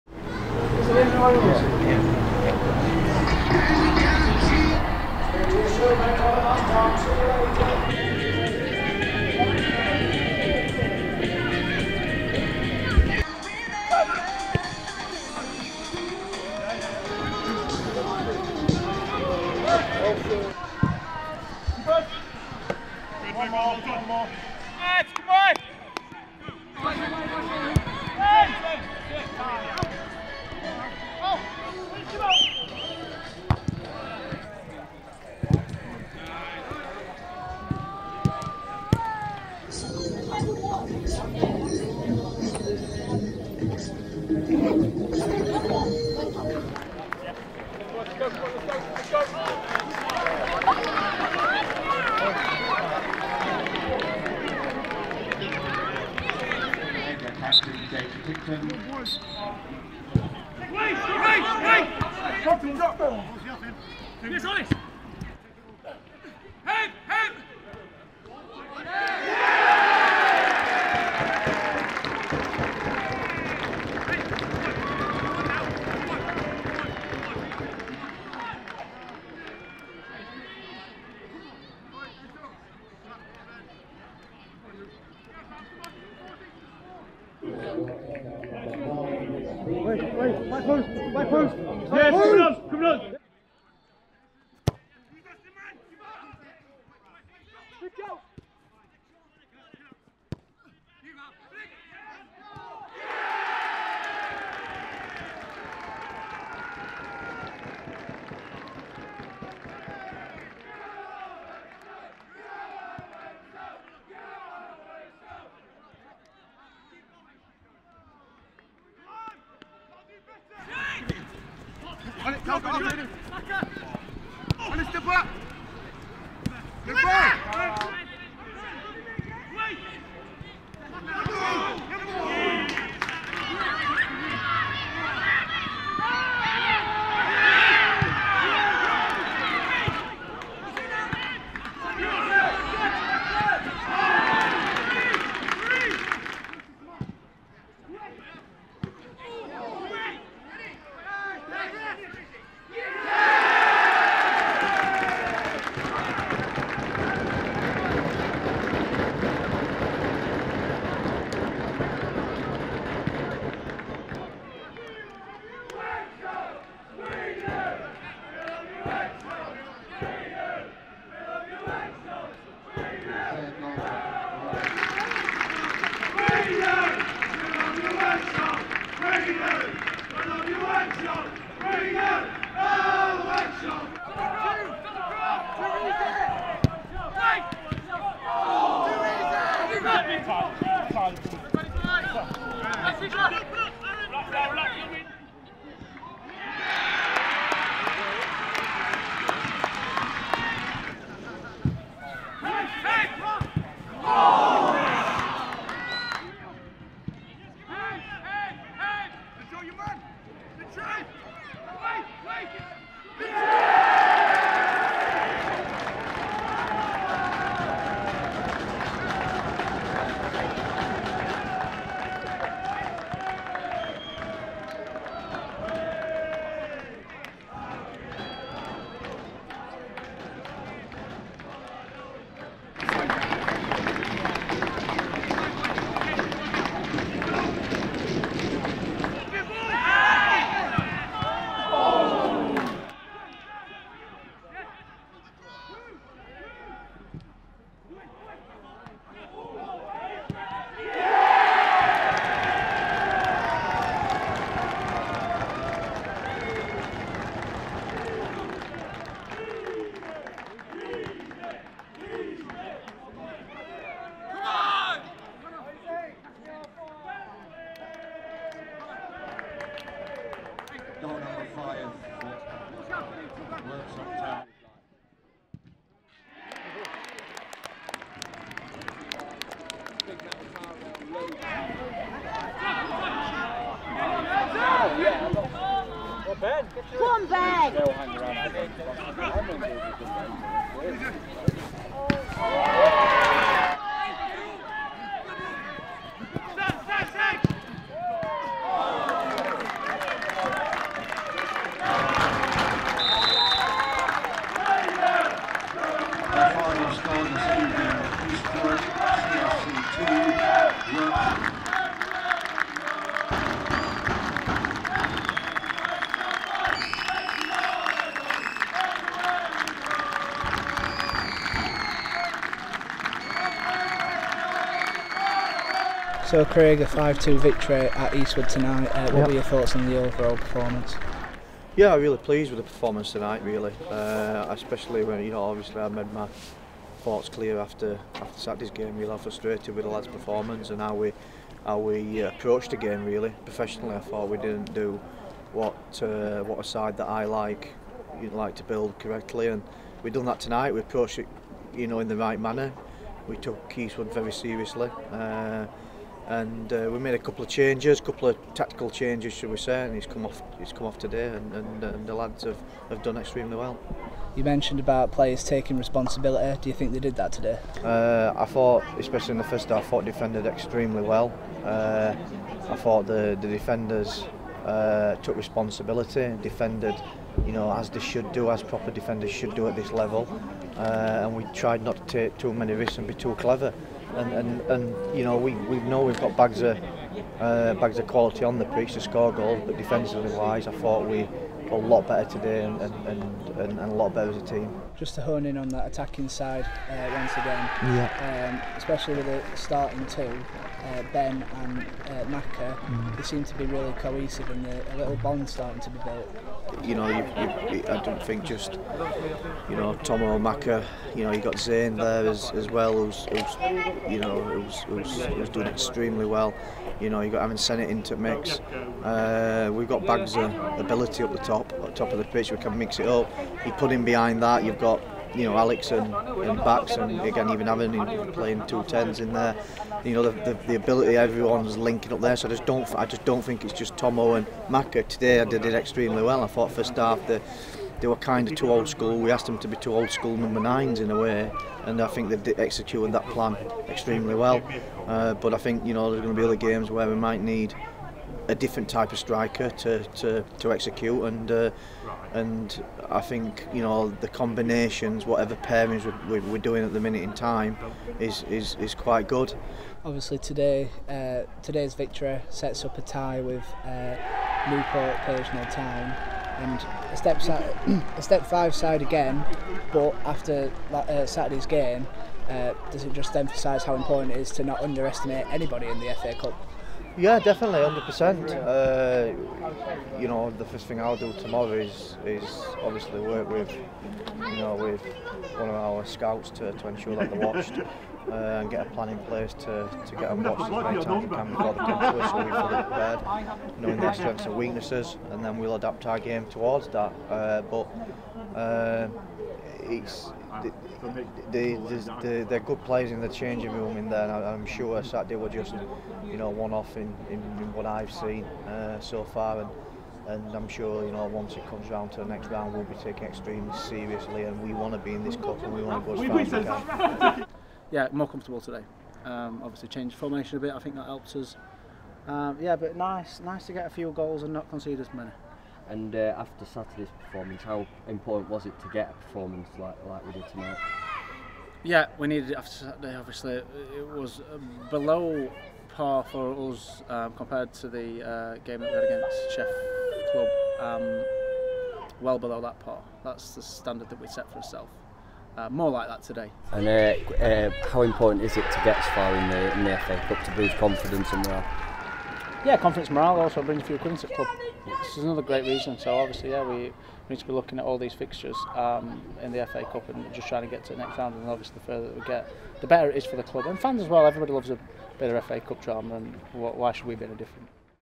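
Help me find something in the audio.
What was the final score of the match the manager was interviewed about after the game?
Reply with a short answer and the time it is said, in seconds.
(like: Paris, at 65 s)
5-2, at 326 s.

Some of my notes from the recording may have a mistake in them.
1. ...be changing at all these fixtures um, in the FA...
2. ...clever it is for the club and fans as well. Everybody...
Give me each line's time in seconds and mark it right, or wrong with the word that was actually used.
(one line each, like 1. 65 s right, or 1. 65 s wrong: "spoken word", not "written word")
1. 557 s wrong: "looking", not "changing"
2. 562 s wrong: "better", not "clever".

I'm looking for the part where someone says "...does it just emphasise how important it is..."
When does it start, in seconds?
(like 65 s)
472 s.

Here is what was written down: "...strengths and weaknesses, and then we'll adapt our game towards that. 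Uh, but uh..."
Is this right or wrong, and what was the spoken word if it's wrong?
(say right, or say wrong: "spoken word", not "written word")
right.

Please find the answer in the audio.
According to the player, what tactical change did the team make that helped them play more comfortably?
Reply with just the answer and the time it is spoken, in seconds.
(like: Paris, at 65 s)
changed formation, at 519 s.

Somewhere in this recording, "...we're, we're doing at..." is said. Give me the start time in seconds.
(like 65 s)
456 s.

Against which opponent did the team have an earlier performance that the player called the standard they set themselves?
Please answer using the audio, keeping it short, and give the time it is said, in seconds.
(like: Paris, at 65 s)
Chef Club, at 539 s.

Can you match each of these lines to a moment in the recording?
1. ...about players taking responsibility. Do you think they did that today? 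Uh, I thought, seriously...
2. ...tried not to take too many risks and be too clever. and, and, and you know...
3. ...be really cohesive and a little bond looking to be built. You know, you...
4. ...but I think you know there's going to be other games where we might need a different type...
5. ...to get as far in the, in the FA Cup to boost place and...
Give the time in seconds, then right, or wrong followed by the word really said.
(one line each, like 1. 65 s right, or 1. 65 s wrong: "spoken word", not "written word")
1. 364 s wrong: "especially", not "seriously"
2. 381 s right
3. 403 s wrong: "starting", not "looking"
4. 445 s right
5. 548 s wrong: "confidence", not "place".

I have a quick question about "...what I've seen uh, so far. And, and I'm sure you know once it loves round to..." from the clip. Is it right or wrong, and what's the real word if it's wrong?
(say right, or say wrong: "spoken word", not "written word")
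wrong: "comes", not "loves".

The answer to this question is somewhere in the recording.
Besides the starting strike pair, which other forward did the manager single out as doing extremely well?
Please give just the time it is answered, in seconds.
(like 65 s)
411 s.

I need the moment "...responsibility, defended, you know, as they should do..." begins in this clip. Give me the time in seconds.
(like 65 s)
375 s.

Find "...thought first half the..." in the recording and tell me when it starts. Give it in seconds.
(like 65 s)
436 s.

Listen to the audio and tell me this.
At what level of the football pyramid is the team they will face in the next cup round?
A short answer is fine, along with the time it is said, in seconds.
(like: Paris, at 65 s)
Step five, at 468 s.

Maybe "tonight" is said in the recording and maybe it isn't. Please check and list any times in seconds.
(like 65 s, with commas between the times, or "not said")
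328 s, 333 s, 350 s, 530 s.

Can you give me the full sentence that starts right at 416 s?
You know, you've got having sent it into mix.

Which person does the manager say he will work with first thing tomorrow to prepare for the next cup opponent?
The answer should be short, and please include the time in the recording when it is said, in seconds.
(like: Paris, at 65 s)
one of our scouts, at 485 s.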